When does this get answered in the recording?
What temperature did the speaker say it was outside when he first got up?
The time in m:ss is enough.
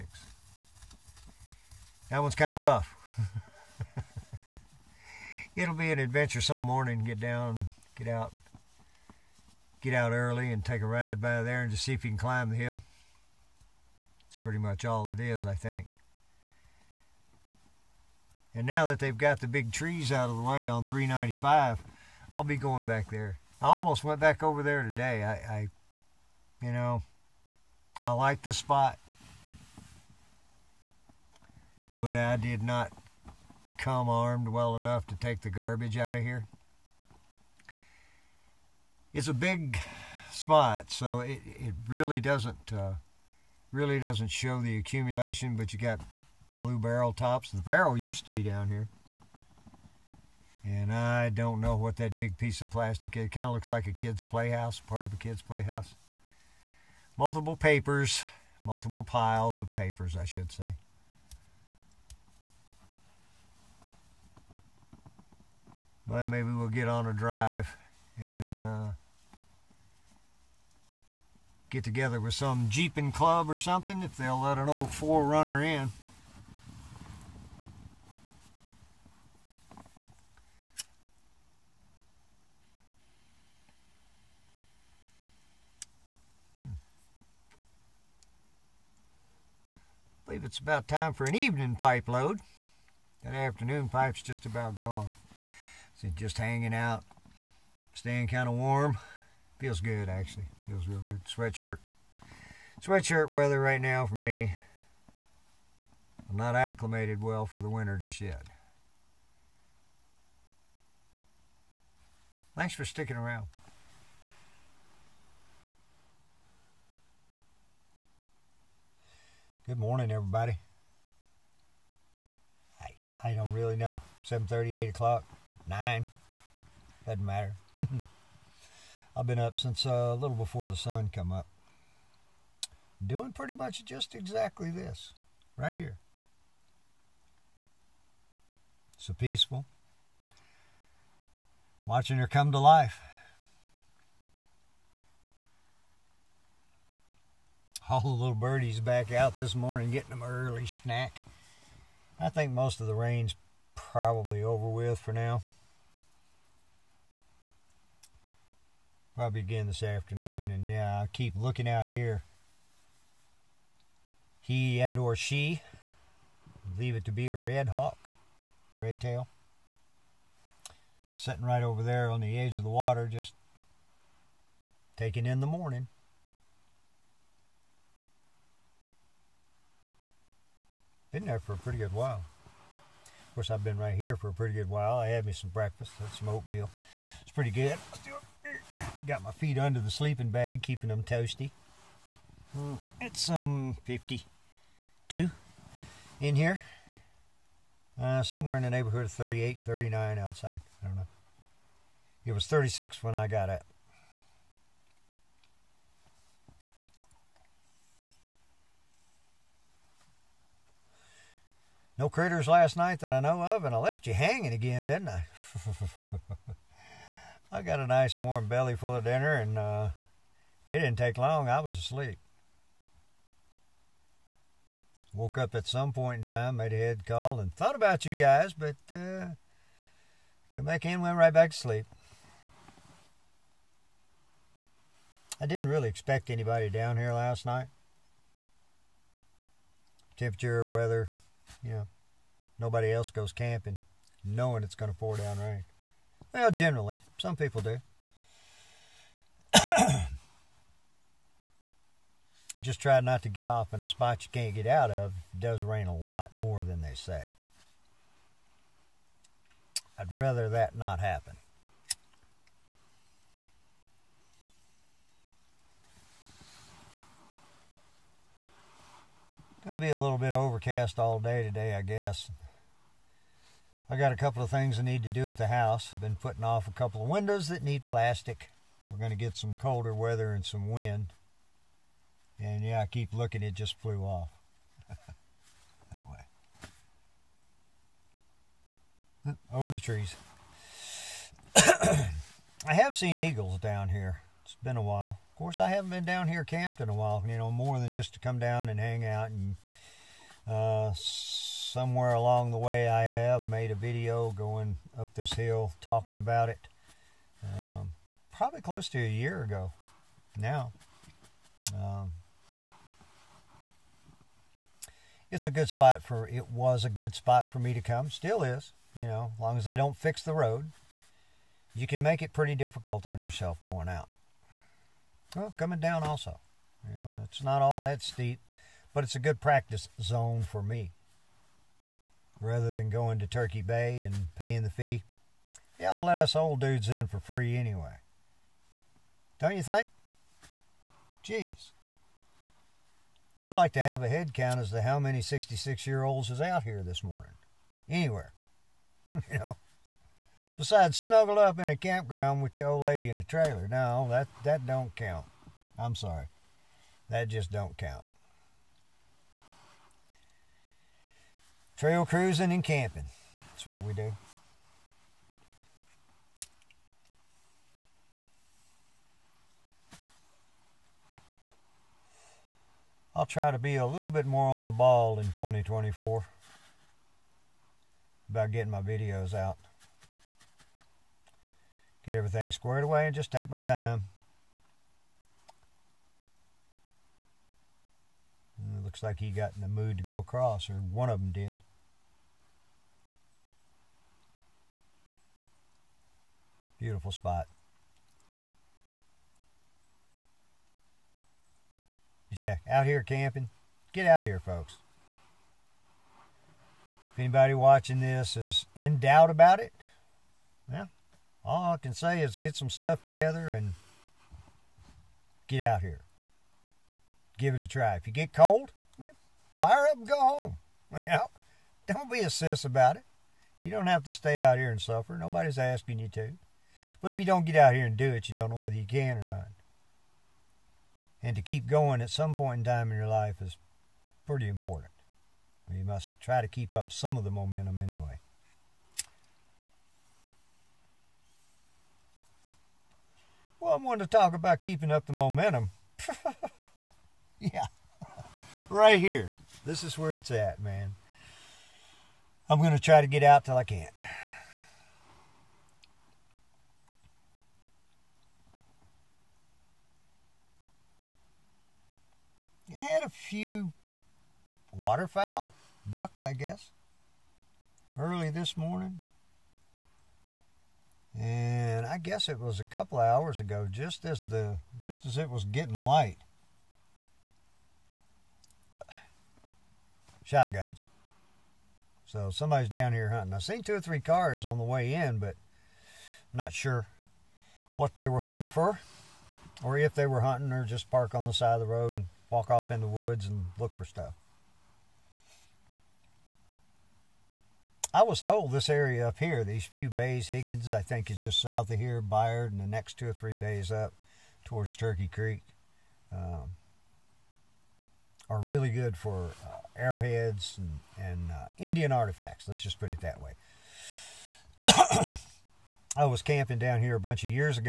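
3:22.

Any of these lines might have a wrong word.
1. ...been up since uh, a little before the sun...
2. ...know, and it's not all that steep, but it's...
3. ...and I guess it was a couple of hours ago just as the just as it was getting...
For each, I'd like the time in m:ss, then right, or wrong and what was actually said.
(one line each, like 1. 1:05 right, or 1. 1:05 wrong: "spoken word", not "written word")
1. 2:09 right
2. 5:26 right
3. 7:51 right.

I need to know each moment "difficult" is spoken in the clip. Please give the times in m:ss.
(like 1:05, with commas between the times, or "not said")
5:22.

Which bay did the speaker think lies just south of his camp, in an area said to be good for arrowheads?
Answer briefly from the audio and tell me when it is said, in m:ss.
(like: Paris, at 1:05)
Higgins, at 8:20.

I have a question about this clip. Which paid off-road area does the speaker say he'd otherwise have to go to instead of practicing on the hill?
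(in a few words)
Turkey Bay.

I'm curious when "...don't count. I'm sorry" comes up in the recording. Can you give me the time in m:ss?
5:54.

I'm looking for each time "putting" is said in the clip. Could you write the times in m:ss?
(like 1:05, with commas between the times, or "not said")
4:36.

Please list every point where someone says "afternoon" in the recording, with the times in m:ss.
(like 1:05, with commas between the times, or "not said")
1:33, 2:39.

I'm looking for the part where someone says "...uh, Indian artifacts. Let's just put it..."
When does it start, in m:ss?
8:31.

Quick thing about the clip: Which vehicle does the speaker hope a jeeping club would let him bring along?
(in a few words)
4Runner.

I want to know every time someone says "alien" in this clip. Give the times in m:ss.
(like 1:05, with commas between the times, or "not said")
not said.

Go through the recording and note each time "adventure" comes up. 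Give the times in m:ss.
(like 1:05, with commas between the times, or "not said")
0:05.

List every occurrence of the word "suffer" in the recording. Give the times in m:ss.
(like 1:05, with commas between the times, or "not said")
7:04.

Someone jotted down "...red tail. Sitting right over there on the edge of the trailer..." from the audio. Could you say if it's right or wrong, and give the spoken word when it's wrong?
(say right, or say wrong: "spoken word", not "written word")
wrong: "water", not "trailer".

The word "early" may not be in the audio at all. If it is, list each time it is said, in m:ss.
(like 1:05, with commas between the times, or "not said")
0:10, 2:30, 7:47.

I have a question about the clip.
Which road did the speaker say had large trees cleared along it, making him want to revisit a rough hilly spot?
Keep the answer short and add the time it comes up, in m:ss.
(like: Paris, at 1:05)
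395, at 0:20.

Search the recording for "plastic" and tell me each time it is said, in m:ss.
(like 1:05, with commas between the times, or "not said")
0:52, 4:37.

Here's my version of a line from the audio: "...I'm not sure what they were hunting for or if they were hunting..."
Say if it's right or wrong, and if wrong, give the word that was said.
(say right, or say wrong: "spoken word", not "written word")
right.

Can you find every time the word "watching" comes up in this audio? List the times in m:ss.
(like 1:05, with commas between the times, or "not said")
2:21, 6:47.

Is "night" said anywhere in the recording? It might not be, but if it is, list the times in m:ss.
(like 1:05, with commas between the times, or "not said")
3:32, 3:57.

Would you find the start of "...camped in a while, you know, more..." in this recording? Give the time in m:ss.
4:56.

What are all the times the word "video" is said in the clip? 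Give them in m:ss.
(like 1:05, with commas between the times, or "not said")
5:03, 6:18.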